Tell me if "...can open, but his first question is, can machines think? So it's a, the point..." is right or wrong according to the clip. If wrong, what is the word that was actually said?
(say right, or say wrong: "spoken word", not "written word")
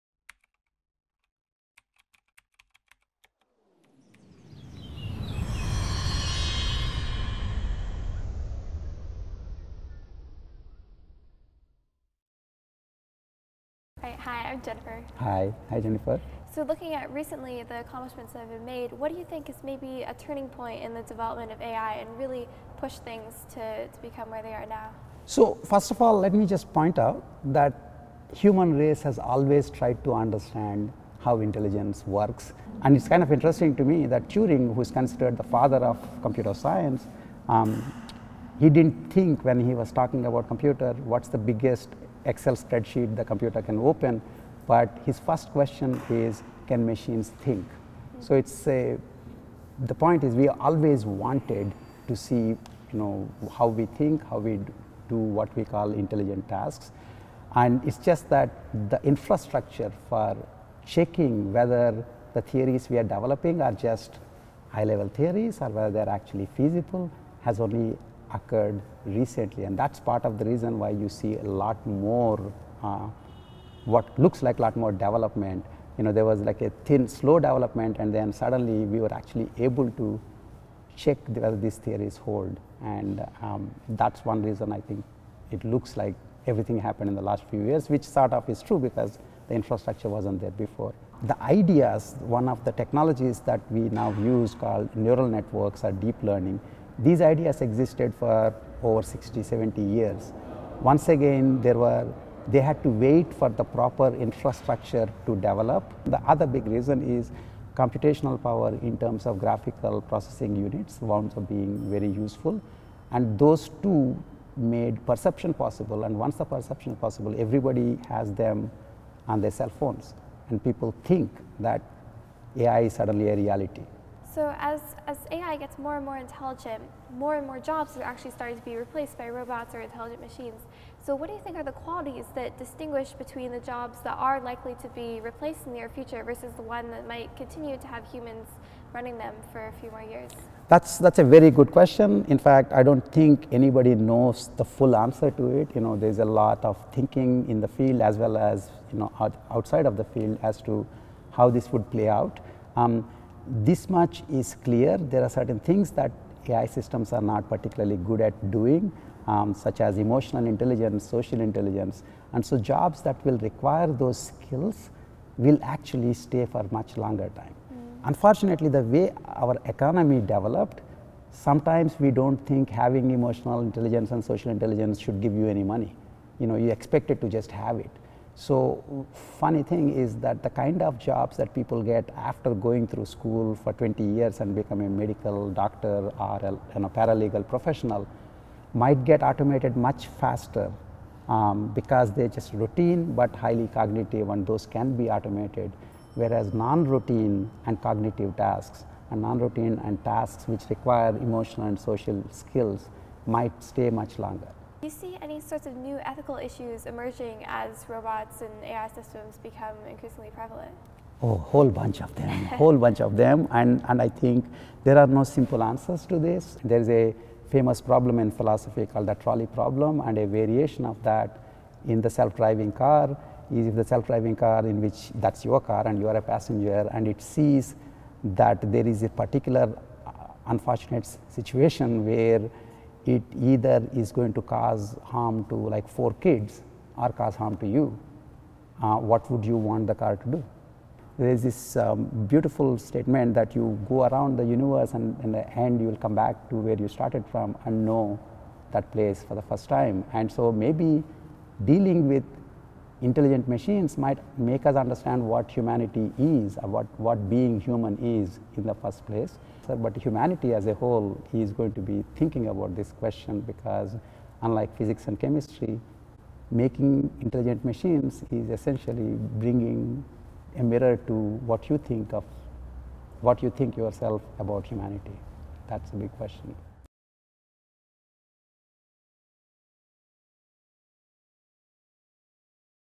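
right.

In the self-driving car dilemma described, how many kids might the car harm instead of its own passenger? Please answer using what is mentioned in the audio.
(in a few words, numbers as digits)
4.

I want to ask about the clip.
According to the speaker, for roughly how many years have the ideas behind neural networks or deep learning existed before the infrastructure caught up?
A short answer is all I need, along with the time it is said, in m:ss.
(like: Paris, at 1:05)
60, 70 years, at 1:39.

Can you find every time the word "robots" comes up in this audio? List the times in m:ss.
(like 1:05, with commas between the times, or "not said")
2:09, 3:27.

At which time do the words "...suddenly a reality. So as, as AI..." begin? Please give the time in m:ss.
2:02.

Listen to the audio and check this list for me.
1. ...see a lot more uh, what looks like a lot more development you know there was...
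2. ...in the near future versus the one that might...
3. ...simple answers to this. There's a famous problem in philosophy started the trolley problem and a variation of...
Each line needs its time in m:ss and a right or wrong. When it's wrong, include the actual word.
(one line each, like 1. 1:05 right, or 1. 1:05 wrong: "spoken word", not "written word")
1. 1:11 right
2. 2:15 right
3. 3:35 wrong: "called", not "started".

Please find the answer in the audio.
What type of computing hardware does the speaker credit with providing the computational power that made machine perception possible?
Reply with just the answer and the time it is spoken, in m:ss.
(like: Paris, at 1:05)
graphical processing units, at 1:49.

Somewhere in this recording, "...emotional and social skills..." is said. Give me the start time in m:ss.
3:21.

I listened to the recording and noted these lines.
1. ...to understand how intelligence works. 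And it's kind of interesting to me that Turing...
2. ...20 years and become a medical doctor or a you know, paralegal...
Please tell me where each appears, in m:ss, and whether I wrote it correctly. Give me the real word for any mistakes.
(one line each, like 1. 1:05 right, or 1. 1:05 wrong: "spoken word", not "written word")
1. 0:30 right
2. 3:03 right.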